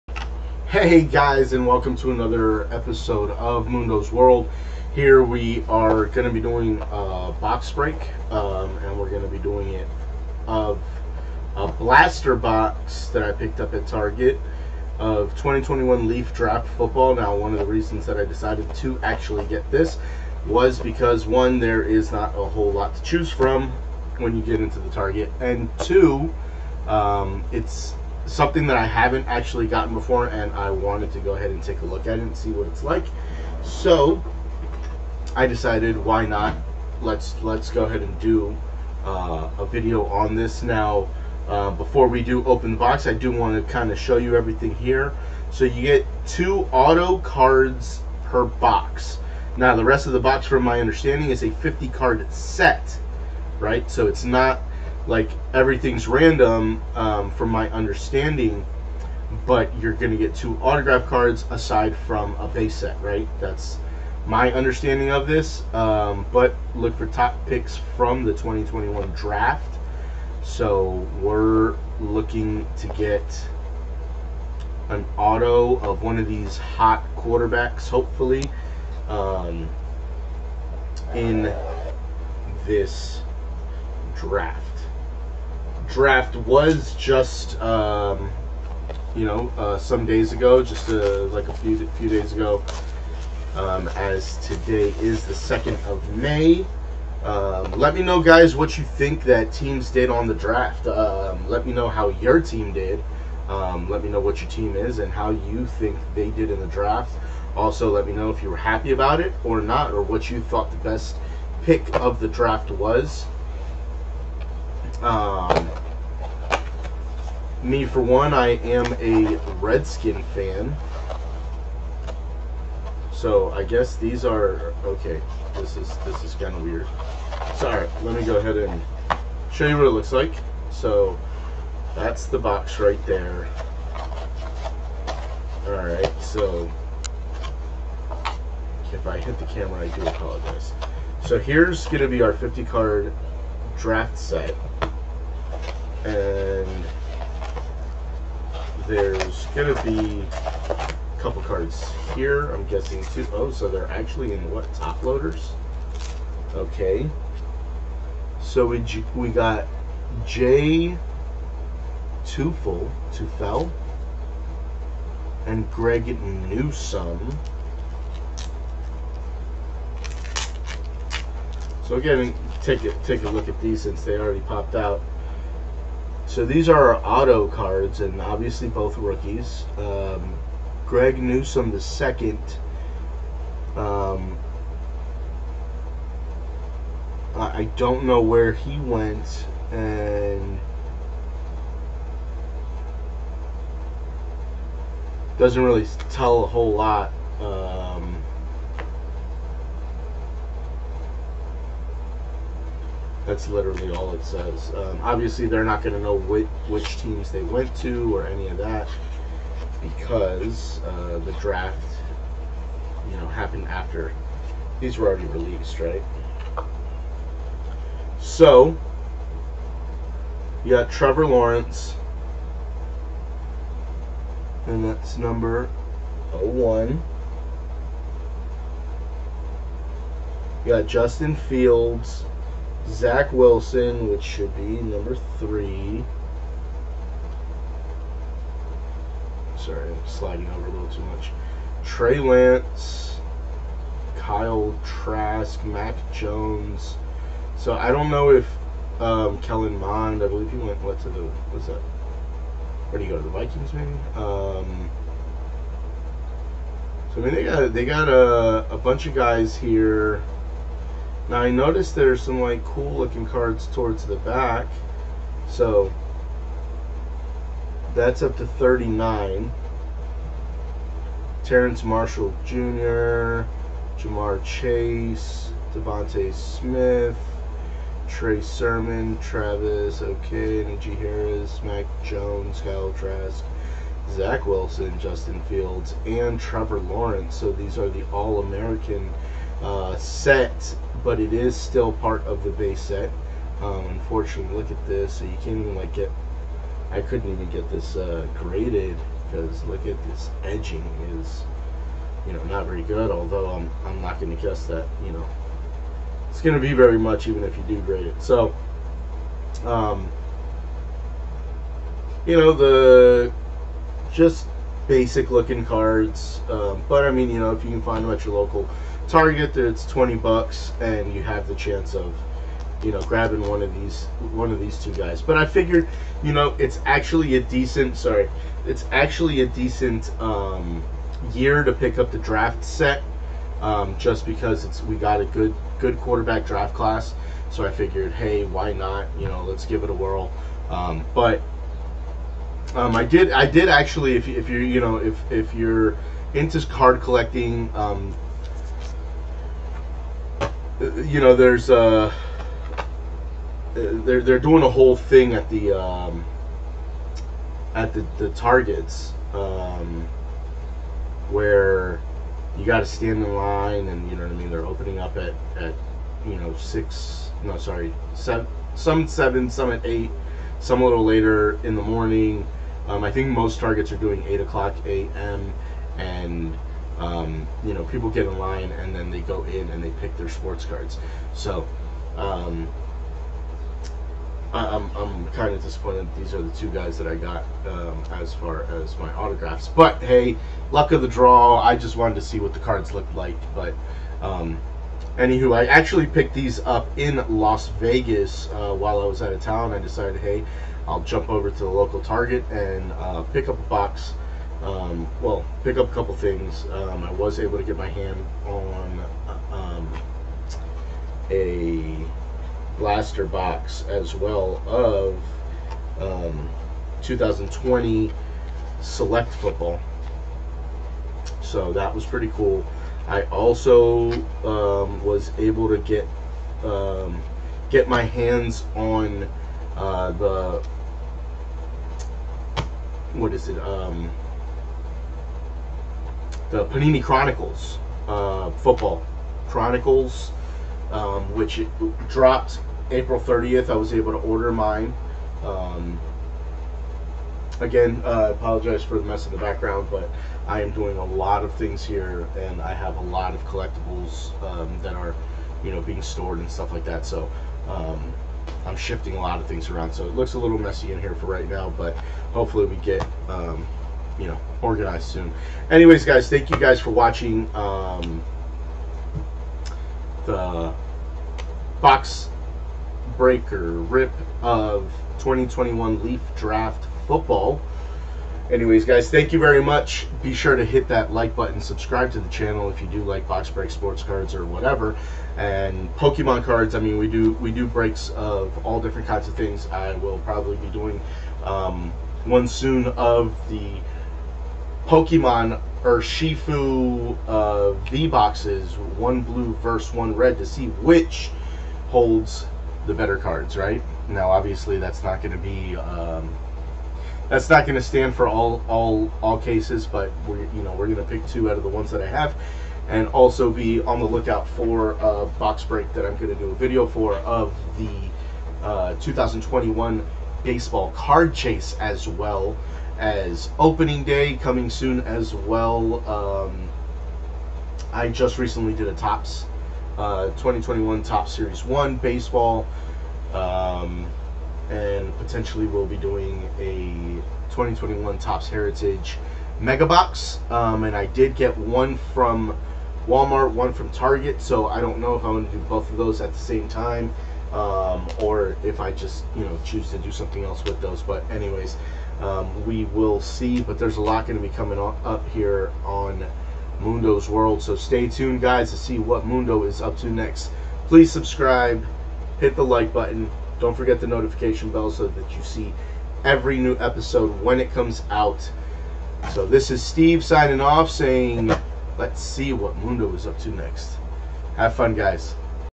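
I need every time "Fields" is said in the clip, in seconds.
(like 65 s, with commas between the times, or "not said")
231 s, 285 s.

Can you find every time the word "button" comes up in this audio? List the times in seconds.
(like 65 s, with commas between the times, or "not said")
481 s, 562 s.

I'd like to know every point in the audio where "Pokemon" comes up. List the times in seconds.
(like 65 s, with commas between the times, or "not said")
485 s, 494 s.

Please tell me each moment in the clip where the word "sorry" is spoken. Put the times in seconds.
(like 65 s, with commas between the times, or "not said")
127 s, 239 s, 327 s, 367 s.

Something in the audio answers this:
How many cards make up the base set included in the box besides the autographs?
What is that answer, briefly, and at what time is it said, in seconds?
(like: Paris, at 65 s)
50, at 51 s.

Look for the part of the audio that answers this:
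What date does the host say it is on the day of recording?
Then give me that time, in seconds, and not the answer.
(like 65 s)
95 s.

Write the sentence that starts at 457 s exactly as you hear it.
So um, I'm shifting a lot of things around.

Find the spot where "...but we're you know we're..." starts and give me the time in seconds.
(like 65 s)
509 s.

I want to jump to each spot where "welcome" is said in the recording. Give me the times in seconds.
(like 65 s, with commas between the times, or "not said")
1 s.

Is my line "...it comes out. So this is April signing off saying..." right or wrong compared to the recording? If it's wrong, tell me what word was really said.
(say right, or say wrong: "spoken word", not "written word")
wrong: "Steve", not "April".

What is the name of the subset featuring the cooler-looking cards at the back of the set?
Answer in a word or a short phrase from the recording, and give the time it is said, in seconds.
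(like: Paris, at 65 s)
All American, at 288 s.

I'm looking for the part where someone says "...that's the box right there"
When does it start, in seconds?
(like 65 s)
131 s.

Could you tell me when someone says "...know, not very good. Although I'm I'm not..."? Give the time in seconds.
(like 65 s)
302 s.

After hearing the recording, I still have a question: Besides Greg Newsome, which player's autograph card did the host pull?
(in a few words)
Jay Tufele.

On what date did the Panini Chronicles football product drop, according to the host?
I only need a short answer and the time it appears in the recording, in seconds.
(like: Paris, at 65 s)
April 30, at 442 s.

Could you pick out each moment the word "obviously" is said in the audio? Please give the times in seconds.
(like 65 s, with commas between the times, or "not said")
178 s, 205 s, 504 s.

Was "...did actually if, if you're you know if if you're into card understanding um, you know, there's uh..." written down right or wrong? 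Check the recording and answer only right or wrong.
wrong.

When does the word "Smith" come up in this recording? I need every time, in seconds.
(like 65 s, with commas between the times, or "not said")
276 s.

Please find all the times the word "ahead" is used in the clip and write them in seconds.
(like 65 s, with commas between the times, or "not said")
31 s, 37 s, 128 s.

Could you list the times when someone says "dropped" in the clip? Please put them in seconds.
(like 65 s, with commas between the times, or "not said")
442 s.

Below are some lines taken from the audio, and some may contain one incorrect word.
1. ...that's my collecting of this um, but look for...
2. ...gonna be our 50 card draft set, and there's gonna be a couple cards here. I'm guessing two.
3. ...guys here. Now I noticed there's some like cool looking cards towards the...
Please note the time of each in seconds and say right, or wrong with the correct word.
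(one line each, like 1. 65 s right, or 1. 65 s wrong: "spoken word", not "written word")
1. 63 s wrong: "understanding", not "collecting"
2. 141 s right
3. 259 s right.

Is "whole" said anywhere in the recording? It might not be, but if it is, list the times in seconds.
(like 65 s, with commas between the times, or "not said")
22 s, 196 s, 354 s.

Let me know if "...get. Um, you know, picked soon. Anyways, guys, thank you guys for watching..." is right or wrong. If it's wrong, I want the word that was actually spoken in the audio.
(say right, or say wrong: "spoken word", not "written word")
wrong: "organized", not "picked".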